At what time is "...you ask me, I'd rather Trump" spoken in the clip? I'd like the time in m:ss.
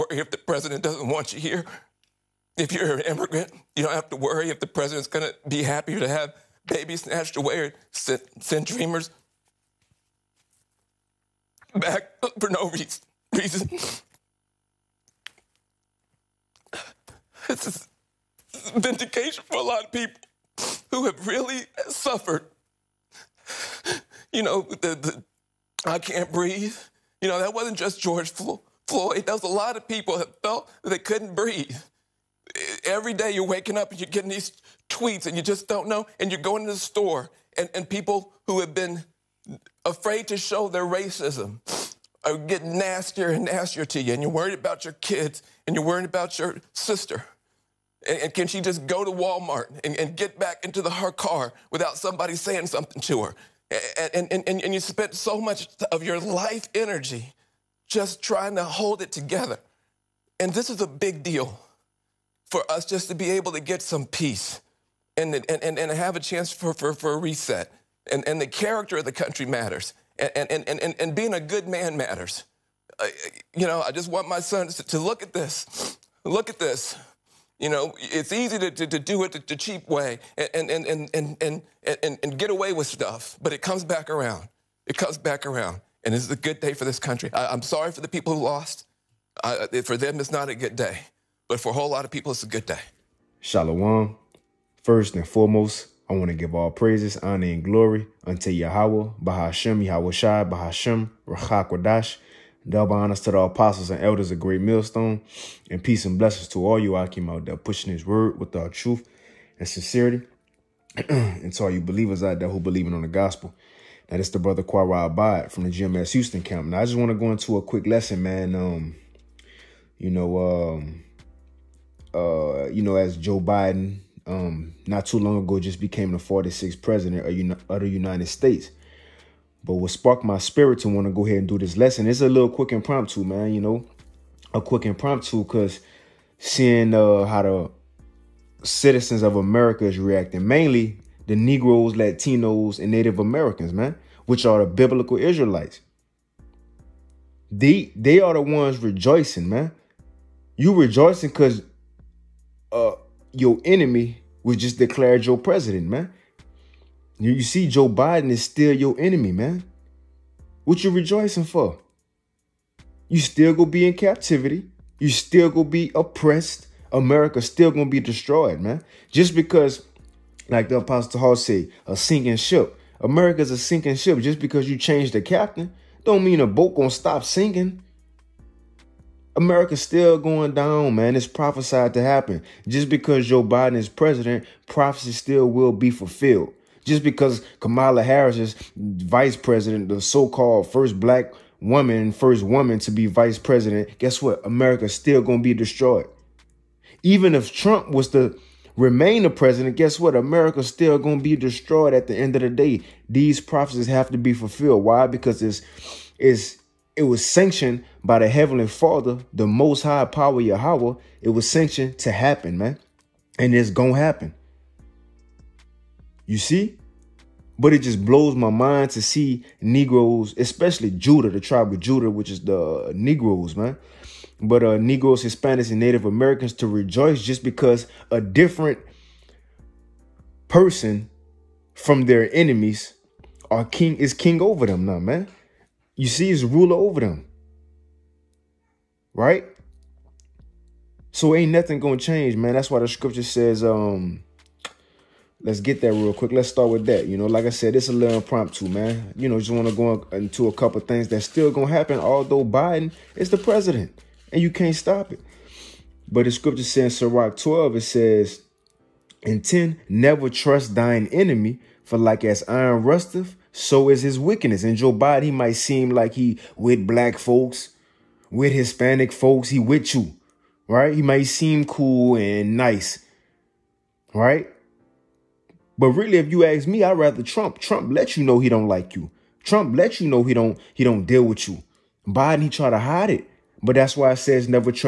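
4:36.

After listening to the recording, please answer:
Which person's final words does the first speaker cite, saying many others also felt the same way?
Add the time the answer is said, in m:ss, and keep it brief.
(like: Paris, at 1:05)
George Floyd, at 0:28.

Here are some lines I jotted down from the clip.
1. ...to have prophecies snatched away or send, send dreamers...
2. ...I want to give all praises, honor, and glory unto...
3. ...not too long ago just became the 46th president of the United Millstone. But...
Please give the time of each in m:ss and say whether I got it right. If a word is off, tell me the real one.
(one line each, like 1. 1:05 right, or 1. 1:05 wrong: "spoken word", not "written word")
1. 0:05 wrong: "babies", not "prophecies"
2. 1:36 right
3. 2:04 wrong: "States", not "Millstone".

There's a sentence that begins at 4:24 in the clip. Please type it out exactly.
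And Joe Biden, he might seem like he with black folks, with Hispanic folks, he with you, right?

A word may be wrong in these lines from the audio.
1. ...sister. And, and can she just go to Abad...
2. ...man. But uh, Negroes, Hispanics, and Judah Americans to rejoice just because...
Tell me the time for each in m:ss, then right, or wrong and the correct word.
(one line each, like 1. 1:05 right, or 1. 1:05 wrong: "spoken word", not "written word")
1. 0:46 wrong: "Walmart", not "Abad"
2. 3:43 wrong: "Native", not "Judah".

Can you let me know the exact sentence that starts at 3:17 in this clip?
Even if Trump was to remain the president, guess what?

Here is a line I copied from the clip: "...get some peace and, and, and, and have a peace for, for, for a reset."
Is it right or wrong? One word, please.
wrong.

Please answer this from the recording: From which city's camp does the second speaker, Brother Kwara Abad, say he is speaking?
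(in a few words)
Houston.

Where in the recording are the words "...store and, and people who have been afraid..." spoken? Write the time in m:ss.
0:36.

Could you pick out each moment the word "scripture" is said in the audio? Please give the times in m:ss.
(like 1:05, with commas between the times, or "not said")
4:02, 4:16.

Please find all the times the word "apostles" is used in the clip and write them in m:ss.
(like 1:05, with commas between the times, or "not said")
1:43, 2:50.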